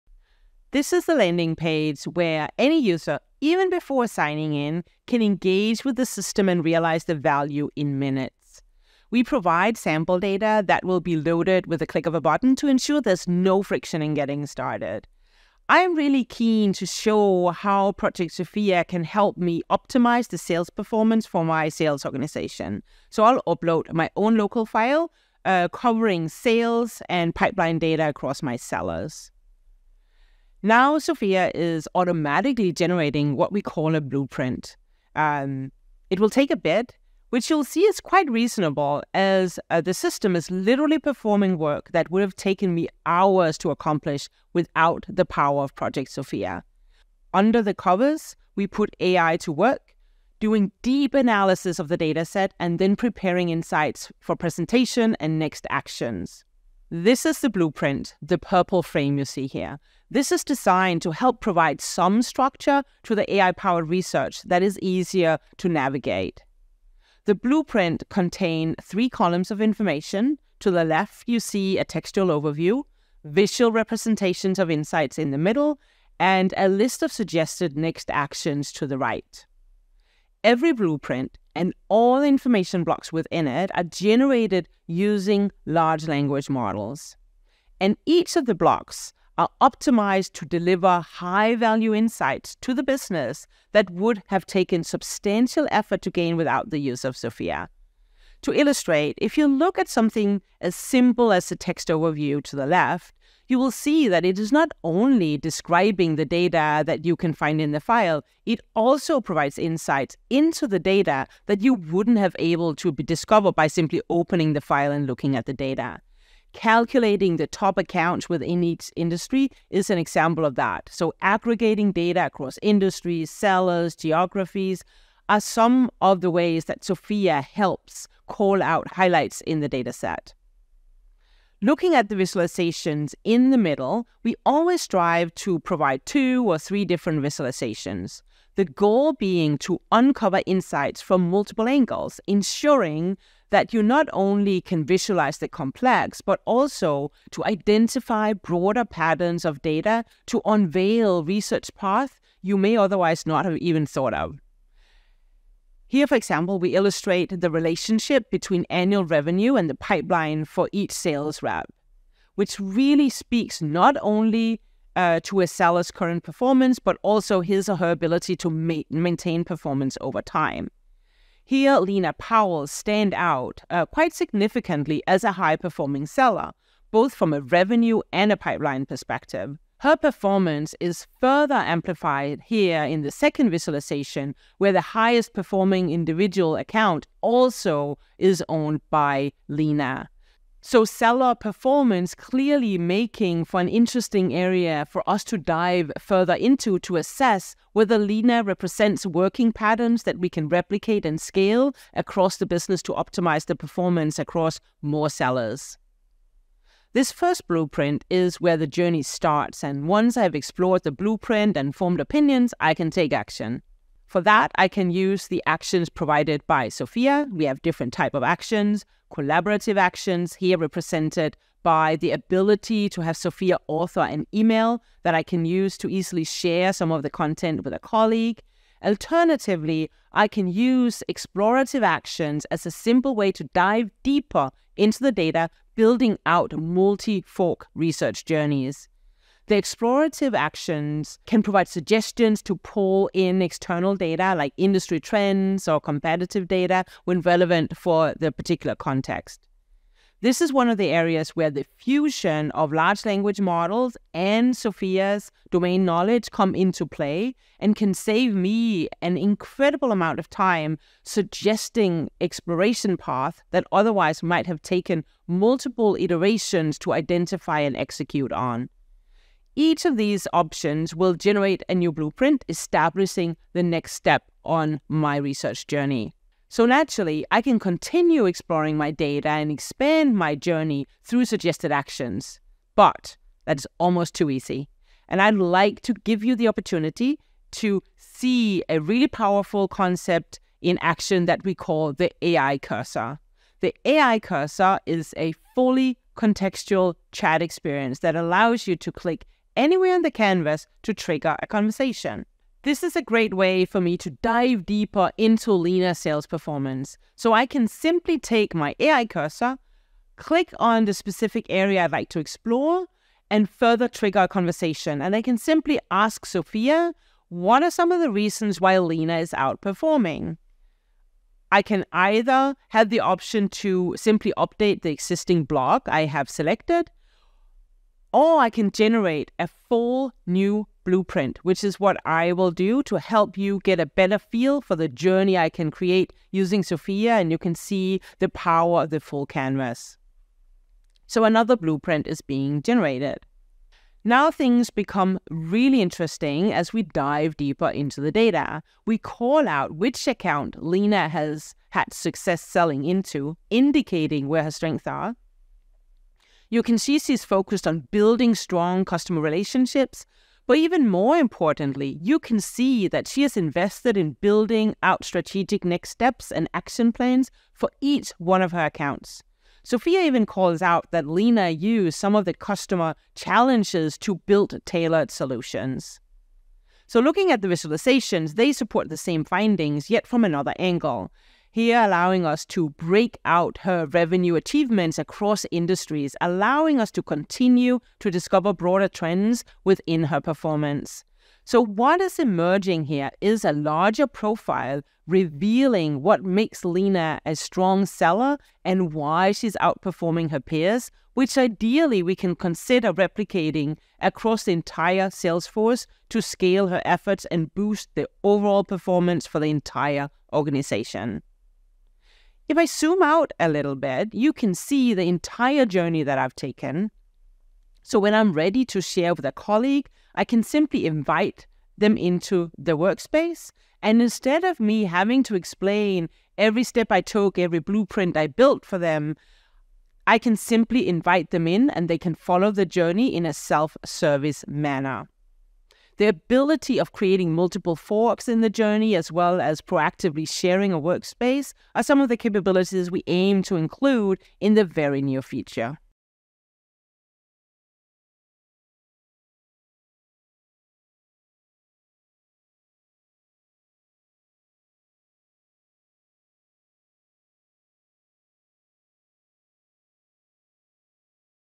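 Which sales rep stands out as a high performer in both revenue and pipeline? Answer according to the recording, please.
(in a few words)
Lena Powell.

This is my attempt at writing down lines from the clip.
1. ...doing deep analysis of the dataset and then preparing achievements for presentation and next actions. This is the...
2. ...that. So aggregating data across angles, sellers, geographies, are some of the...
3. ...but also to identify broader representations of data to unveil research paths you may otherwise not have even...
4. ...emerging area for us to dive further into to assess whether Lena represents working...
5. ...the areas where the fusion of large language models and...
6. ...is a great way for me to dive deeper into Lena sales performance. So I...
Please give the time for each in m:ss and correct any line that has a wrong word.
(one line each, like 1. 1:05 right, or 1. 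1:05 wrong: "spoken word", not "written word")
1. 0:50 wrong: "insights", not "achievements"
2. 2:00 wrong: "industries", not "angles"
3. 2:26 wrong: "patterns", not "representations"
4. 3:13 wrong: "interesting", not "emerging"
5. 4:10 right
6. 5:02 right.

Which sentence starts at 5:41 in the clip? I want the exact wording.
So another blueprint is being generated.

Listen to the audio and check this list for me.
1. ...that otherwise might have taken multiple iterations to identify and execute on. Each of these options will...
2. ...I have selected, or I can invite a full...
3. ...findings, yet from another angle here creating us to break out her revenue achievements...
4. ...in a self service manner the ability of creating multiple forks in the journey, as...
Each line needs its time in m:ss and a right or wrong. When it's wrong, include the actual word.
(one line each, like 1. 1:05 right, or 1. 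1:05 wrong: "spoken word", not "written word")
1. 4:23 right
2. 5:25 wrong: "generate", not "invite"
3. 6:19 wrong: "allowing", not "creating"
4. 7:13 right.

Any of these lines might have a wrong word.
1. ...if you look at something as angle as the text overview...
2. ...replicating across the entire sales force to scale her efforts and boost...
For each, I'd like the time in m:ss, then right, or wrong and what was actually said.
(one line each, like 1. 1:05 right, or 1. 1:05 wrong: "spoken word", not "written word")
1. 1:39 wrong: "simple", not "angle"
2. 6:42 right.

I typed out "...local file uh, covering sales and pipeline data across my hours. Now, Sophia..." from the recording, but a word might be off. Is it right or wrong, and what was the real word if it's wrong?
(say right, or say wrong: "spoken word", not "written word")
wrong: "sellers", not "hours".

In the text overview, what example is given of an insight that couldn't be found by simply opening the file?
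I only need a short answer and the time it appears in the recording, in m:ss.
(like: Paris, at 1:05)
Top accounts within each industry, at 1:57.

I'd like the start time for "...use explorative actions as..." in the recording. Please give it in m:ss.
3:50.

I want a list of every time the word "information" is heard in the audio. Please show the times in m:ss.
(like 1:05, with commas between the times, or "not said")
1:09, 1:22.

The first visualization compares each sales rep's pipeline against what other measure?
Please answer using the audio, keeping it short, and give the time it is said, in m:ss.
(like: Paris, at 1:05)
Annual revenue, at 2:38.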